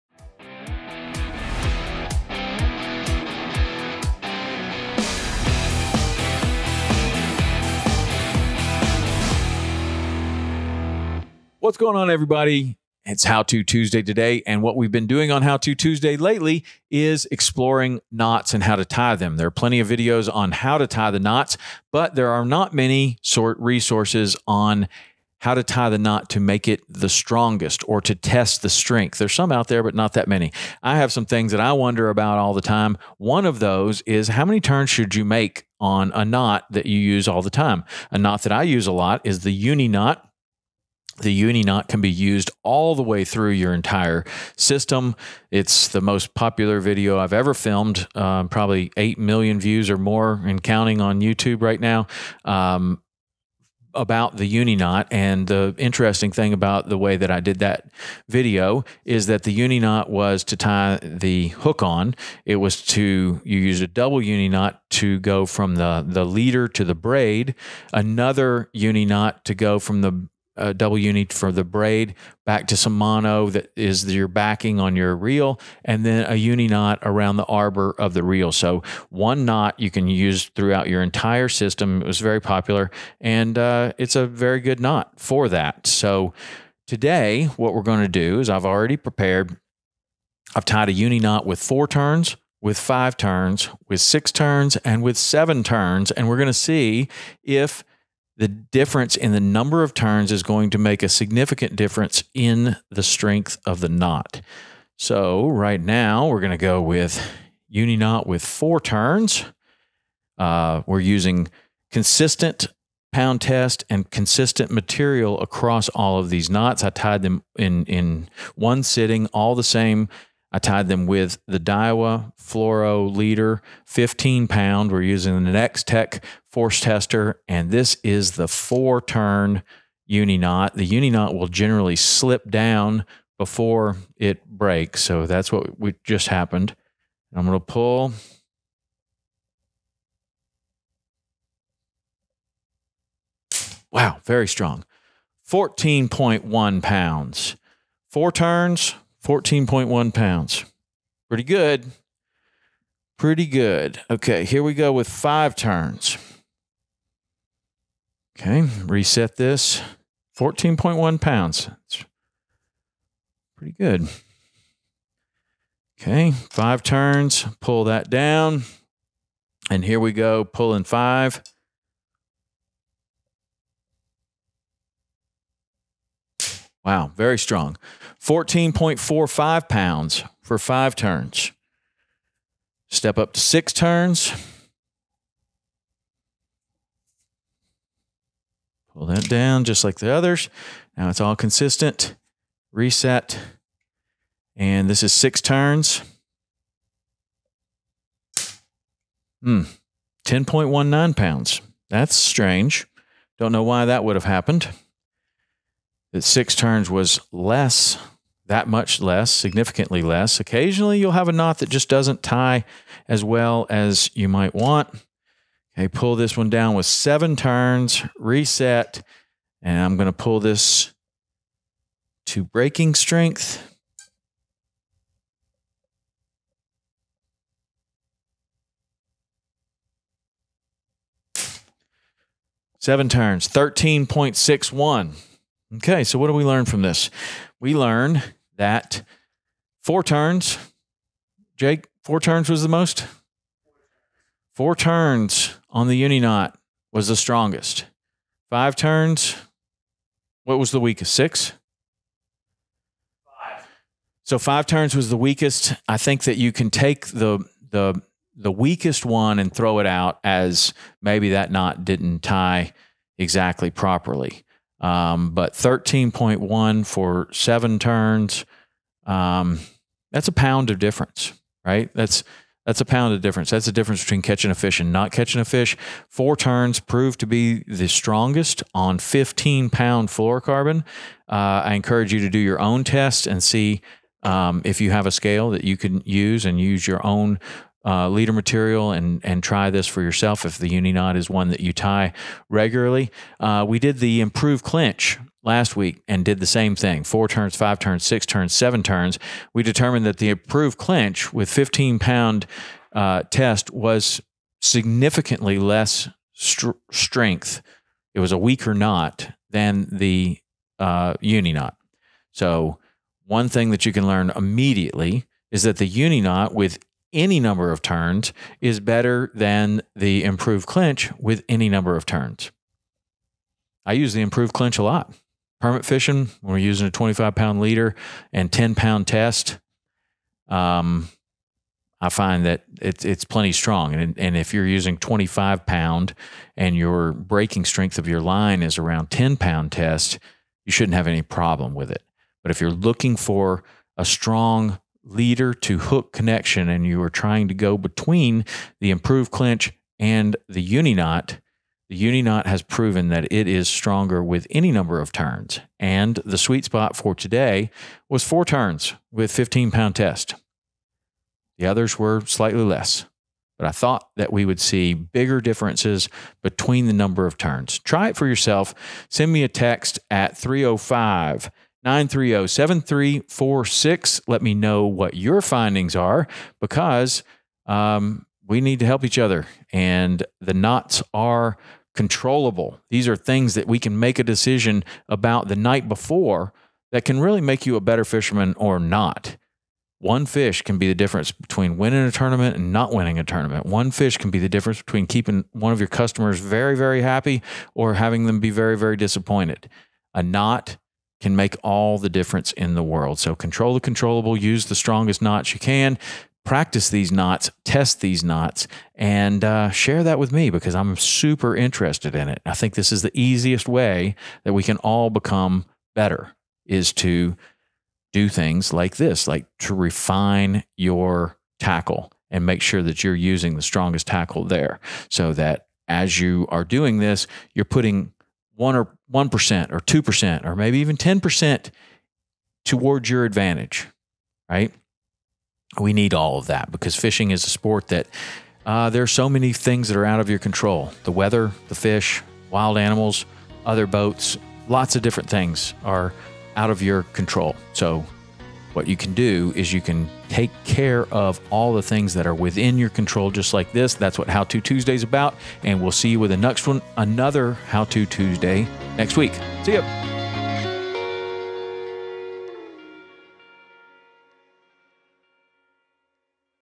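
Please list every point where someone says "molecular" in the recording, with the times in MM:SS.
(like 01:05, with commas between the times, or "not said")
not said.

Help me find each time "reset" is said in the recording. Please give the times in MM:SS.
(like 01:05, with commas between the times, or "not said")
02:38, 03:12, 03:38.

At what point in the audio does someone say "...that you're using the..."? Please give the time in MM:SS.
07:02.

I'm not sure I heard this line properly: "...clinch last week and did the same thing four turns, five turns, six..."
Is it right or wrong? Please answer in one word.
right.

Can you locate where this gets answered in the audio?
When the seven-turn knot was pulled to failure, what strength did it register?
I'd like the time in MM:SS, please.
03:53.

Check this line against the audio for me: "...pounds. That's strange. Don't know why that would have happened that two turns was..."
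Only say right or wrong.
wrong.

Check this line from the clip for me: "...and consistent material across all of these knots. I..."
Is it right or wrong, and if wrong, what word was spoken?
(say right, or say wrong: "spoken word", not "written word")
right.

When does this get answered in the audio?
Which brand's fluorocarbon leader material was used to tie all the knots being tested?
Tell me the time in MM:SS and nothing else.
02:01.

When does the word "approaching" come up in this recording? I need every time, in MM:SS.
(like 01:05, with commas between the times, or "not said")
not said.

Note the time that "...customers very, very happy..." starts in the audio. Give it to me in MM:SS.
06:35.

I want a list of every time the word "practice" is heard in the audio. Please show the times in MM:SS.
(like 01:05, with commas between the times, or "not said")
06:46.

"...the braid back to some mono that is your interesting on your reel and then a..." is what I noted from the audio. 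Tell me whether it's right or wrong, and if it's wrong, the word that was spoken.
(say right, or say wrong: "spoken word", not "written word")
wrong: "backing", not "interesting".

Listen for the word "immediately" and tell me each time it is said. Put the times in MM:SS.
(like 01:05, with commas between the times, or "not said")
05:14.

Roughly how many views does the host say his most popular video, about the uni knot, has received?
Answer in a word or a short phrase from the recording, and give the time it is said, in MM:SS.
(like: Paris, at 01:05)
8 million, at 00:48.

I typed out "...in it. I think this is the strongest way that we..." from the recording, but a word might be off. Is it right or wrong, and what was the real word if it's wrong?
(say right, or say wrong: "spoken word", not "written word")
wrong: "easiest", not "strongest".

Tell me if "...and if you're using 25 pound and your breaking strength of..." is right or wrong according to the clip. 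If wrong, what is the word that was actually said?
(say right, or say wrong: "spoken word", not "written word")
right.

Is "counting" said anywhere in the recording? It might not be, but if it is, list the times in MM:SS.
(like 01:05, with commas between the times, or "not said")
00:50.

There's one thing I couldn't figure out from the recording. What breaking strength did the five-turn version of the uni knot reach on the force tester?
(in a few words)
14.45 pounds.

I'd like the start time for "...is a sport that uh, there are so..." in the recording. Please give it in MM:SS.
07:17.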